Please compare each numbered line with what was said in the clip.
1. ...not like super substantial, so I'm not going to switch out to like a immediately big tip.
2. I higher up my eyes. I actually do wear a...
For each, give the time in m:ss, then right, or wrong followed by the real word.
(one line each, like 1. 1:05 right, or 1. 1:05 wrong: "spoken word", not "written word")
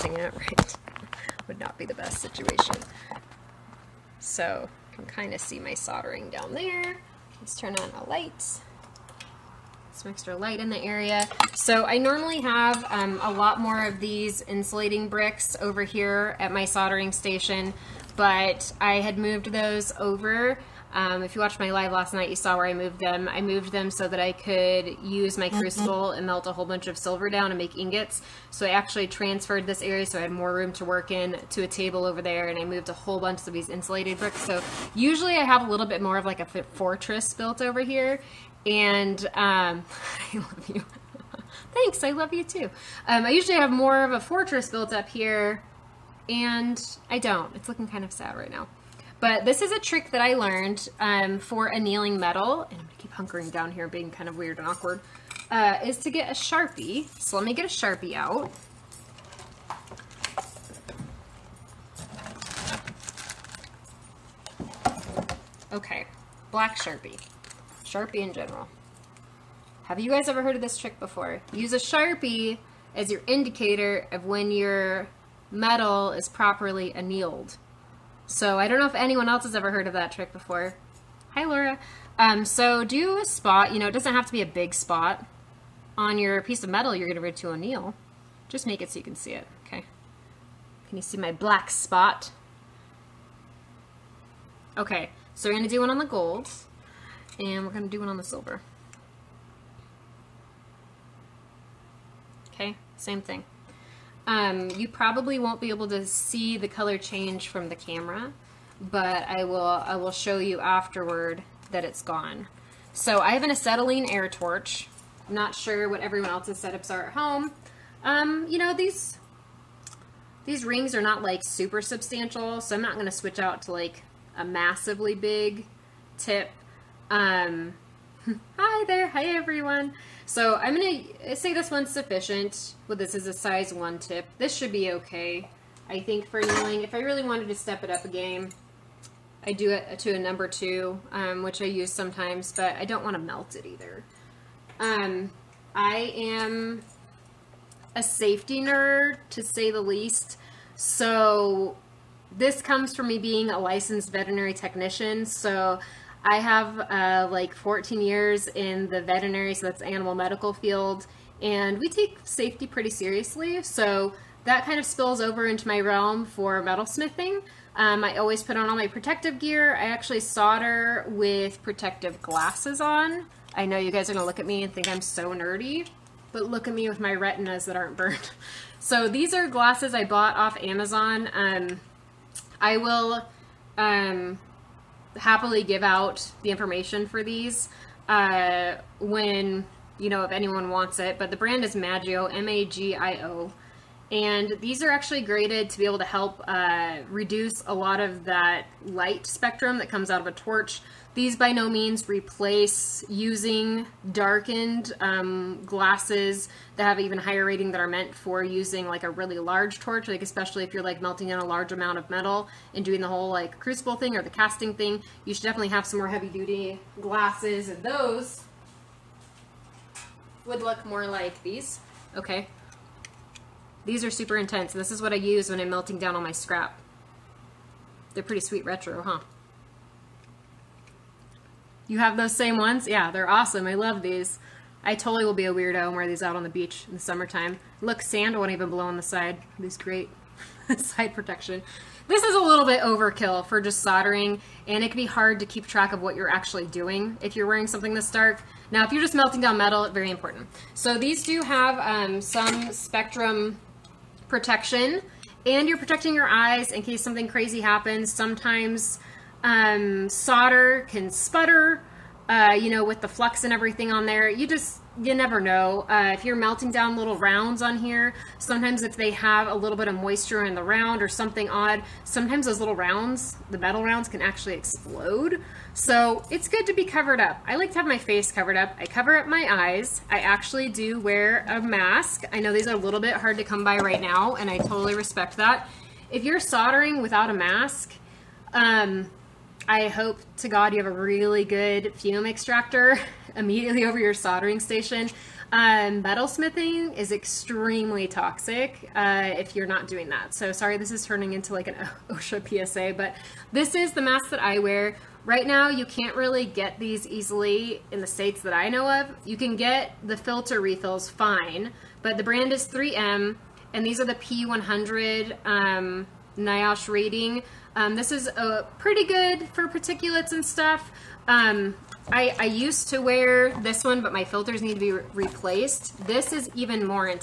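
1. 2:01 wrong: "massively", not "immediately"
2. 4:38 wrong: "cover", not "higher".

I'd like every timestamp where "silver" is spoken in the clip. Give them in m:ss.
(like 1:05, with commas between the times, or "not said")
0:26, 1:38.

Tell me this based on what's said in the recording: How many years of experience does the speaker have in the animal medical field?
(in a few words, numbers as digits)
14.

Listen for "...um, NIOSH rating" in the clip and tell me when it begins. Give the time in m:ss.
5:15.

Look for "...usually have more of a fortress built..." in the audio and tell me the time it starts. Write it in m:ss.
0:43.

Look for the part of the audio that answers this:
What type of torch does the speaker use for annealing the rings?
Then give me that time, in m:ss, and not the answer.
1:53.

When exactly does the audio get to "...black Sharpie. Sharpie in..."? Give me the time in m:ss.
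1:06.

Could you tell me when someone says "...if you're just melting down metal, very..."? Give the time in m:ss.
4:08.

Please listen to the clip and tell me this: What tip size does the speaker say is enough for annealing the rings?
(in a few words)
1.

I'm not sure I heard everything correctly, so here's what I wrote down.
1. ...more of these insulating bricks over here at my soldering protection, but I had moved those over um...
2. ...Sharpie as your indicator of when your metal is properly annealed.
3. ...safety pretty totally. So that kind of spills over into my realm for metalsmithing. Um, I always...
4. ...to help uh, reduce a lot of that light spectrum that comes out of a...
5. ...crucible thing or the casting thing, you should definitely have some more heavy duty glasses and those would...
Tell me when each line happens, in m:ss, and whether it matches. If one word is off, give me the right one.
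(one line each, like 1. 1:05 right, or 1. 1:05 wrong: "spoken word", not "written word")
1. 0:13 wrong: "station", not "protection"
2. 1:11 right
3. 2:42 wrong: "seriously", not "totally"
4. 3:15 right
5. 3:33 right.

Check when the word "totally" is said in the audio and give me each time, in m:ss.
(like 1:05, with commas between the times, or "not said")
3:54, 4:44.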